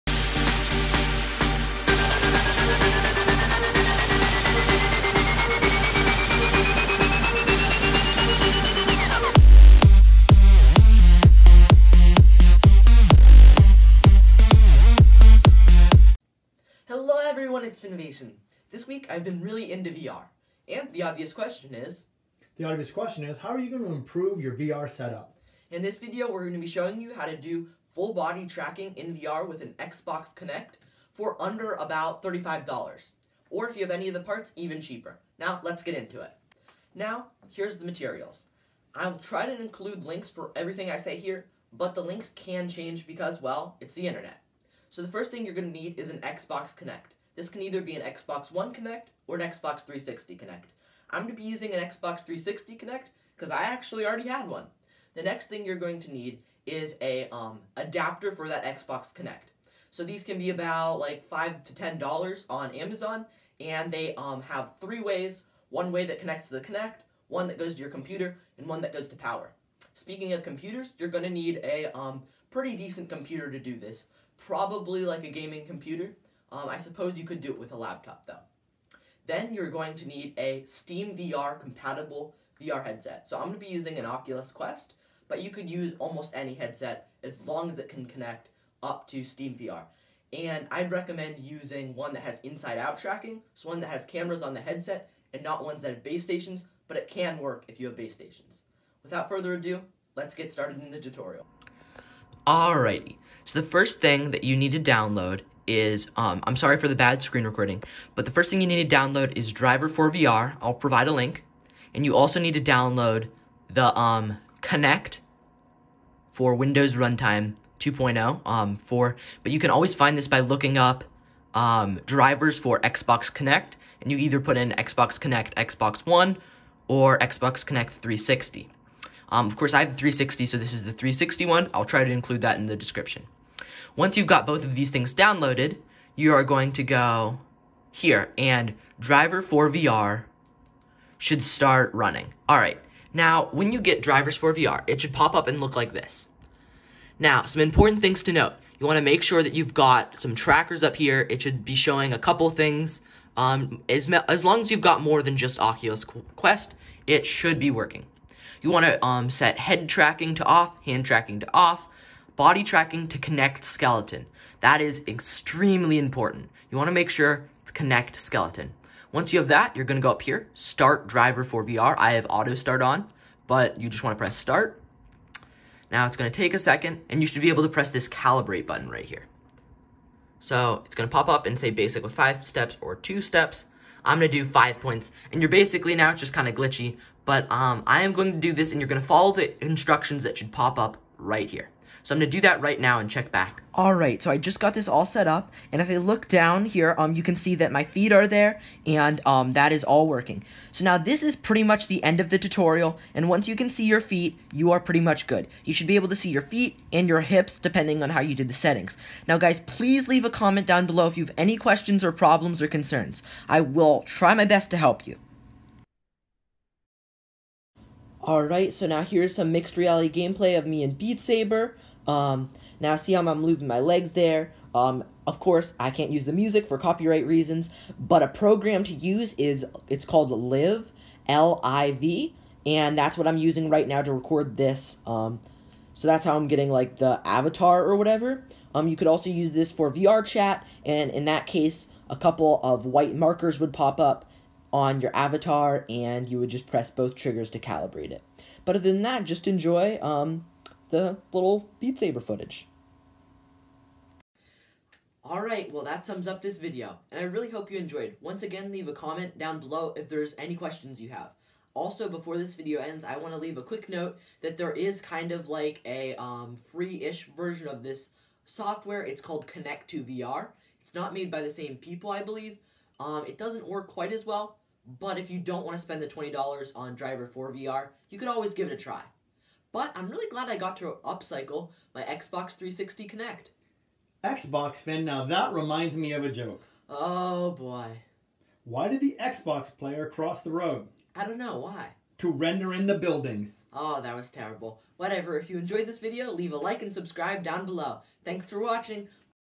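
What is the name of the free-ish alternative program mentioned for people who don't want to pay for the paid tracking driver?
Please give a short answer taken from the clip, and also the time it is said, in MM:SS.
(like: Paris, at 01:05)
Kinect to VR, at 04:29.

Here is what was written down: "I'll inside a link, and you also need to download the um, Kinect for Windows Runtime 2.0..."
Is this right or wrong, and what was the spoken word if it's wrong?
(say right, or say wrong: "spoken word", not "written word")
wrong: "provide", not "inside".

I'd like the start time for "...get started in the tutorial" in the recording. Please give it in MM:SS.
01:40.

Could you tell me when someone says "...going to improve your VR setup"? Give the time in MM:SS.
00:23.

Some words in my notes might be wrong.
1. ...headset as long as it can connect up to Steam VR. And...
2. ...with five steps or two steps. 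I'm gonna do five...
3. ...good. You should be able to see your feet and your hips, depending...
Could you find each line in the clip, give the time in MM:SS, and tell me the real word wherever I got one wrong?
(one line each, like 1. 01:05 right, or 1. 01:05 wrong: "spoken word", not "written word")
1. 01:26 right
2. 03:02 right
3. 03:25 right.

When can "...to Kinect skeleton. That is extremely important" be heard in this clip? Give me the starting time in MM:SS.
02:43.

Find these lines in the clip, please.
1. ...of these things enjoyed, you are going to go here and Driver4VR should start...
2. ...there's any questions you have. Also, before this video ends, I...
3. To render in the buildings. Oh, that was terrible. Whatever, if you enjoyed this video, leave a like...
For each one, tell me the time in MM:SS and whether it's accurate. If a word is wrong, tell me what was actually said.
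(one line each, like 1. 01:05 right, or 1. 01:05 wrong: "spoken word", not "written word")
1. 02:14 wrong: "downloaded", not "enjoyed"
2. 04:20 right
3. 04:52 right.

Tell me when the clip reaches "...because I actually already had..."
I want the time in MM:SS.
00:53.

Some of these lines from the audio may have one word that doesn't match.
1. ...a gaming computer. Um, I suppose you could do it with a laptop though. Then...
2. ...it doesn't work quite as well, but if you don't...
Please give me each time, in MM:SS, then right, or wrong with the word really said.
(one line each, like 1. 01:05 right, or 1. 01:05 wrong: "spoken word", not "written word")
1. 01:15 right
2. 04:33 right.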